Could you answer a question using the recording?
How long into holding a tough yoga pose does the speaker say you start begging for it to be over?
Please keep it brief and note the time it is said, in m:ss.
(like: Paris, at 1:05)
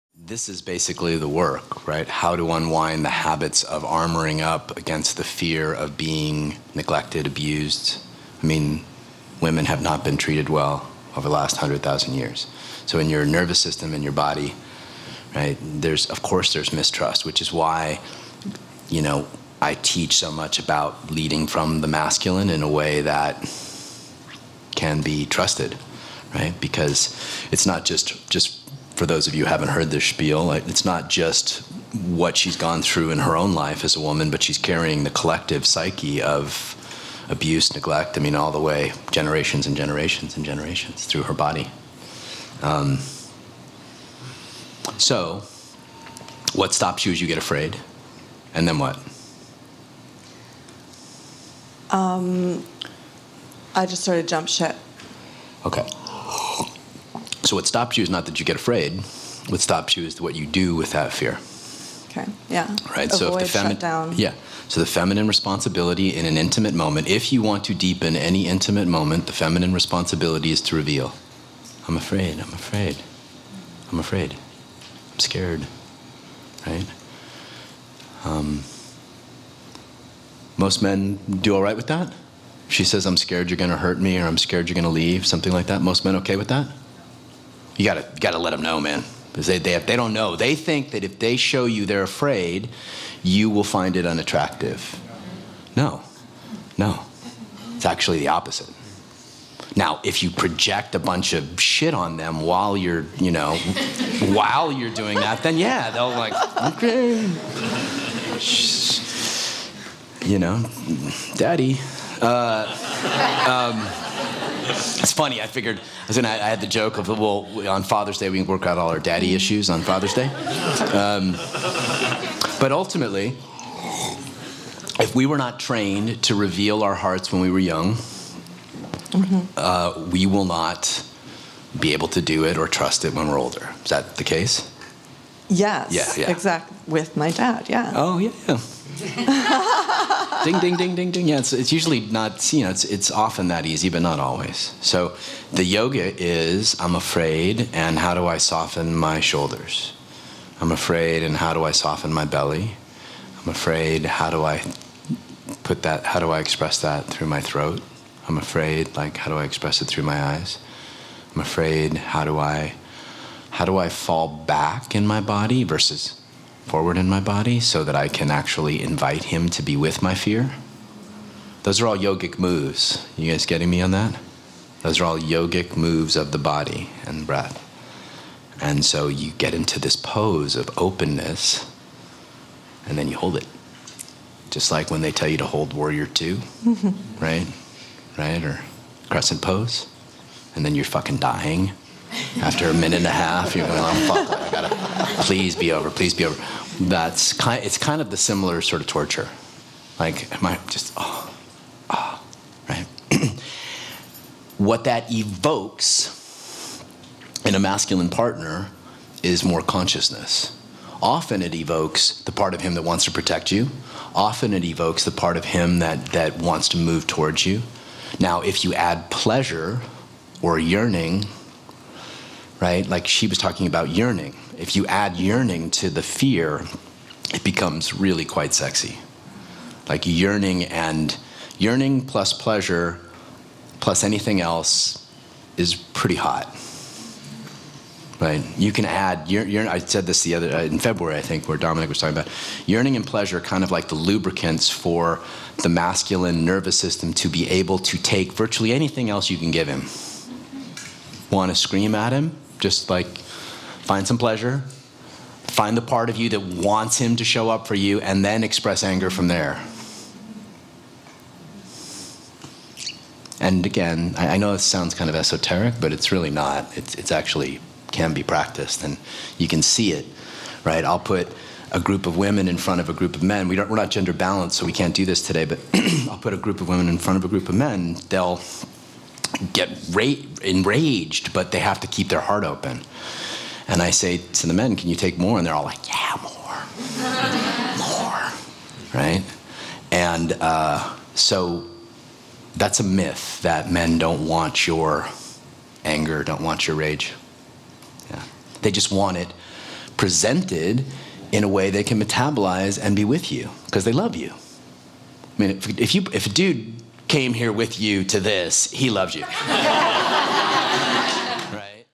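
A minute and a half, at 3:12.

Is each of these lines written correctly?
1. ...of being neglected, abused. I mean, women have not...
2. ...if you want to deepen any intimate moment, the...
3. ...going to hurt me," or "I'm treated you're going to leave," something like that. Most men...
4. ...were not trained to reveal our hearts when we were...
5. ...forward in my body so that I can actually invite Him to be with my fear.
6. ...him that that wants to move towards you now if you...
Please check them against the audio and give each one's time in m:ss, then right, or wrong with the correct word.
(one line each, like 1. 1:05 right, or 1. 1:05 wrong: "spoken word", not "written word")
1. 0:05 right
2. 1:07 right
3. 1:23 wrong: "scared", not "treated"
4. 2:05 right
5. 2:46 right
6. 3:35 right.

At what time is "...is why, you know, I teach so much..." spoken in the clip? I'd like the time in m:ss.
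0:17.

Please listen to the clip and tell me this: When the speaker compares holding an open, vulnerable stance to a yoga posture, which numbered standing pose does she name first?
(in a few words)
Warrior 2.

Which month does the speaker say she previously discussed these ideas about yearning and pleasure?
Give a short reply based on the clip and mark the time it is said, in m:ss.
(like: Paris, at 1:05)
February, at 4:00.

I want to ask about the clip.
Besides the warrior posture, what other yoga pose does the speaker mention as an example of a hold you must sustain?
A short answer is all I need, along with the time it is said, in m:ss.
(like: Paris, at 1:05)
Crescent pose, at 3:09.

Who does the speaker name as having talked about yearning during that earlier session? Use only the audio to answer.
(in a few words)
Dominic.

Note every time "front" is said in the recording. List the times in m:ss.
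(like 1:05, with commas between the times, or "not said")
4:32, 4:36.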